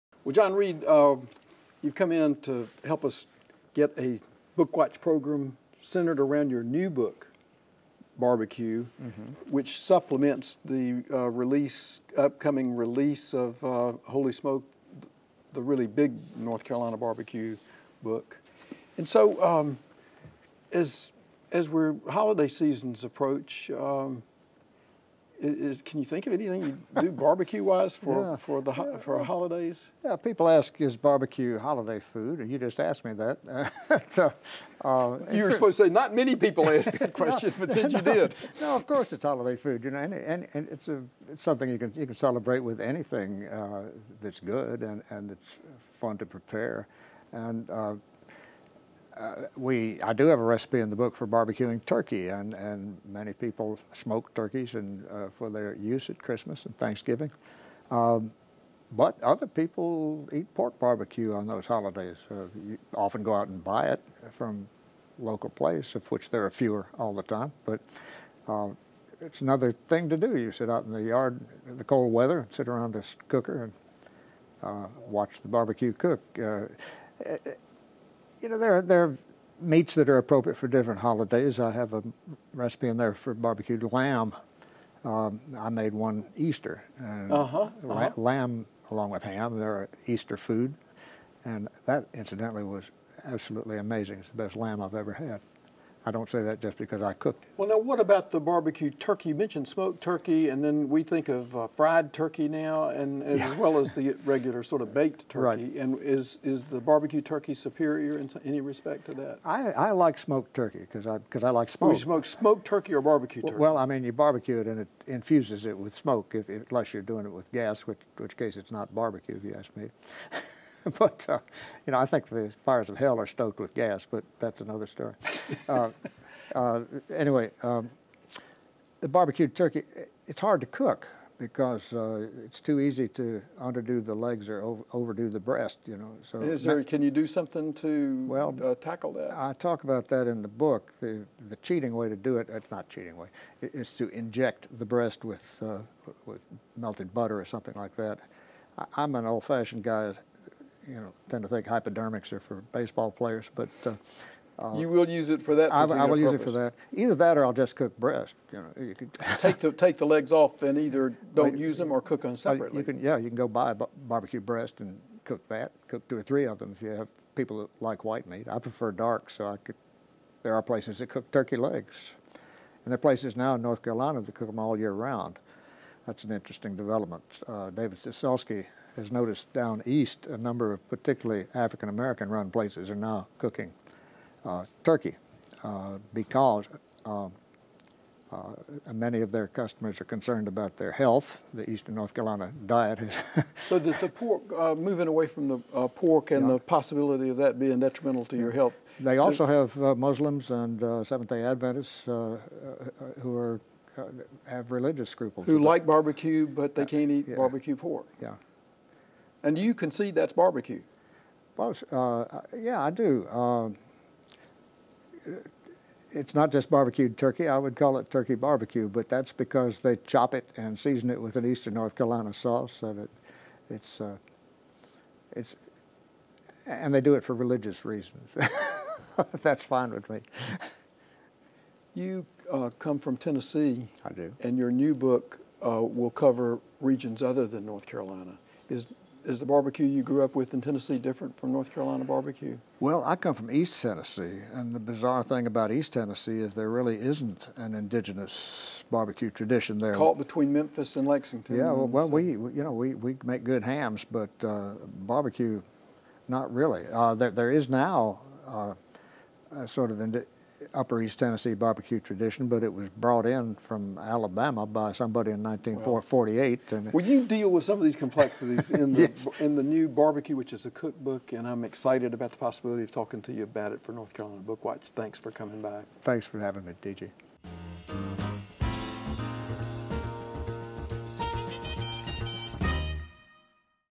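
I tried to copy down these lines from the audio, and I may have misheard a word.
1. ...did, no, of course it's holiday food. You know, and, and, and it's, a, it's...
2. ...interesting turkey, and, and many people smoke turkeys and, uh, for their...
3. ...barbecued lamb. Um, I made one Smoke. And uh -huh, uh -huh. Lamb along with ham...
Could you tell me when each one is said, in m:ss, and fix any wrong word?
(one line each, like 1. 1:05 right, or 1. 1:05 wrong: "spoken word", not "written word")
1. 0:38 right
2. 0:51 wrong: "barbecuing", not "interesting"
3. 1:23 wrong: "Easter", not "Smoke".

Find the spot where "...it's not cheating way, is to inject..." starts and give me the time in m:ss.
2:22.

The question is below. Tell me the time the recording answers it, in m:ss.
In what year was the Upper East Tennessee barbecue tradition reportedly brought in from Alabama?
4:25.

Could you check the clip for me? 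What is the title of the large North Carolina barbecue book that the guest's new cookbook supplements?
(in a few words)
Holy Smoke.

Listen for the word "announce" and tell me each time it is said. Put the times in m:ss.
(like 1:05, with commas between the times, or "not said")
not said.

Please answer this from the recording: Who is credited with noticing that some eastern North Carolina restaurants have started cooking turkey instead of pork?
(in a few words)
David Cecelski.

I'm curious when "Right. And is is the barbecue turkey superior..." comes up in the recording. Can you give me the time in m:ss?
1:45.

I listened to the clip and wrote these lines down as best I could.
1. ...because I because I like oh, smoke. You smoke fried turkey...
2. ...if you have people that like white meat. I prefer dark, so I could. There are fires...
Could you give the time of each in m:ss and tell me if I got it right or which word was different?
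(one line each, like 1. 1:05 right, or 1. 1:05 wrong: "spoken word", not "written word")
1. 1:50 wrong: "smoked", not "fried"
2. 2:46 wrong: "places", not "fires".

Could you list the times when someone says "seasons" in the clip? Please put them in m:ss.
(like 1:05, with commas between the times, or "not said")
0:22, 3:40.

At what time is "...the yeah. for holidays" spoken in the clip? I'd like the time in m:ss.
0:28.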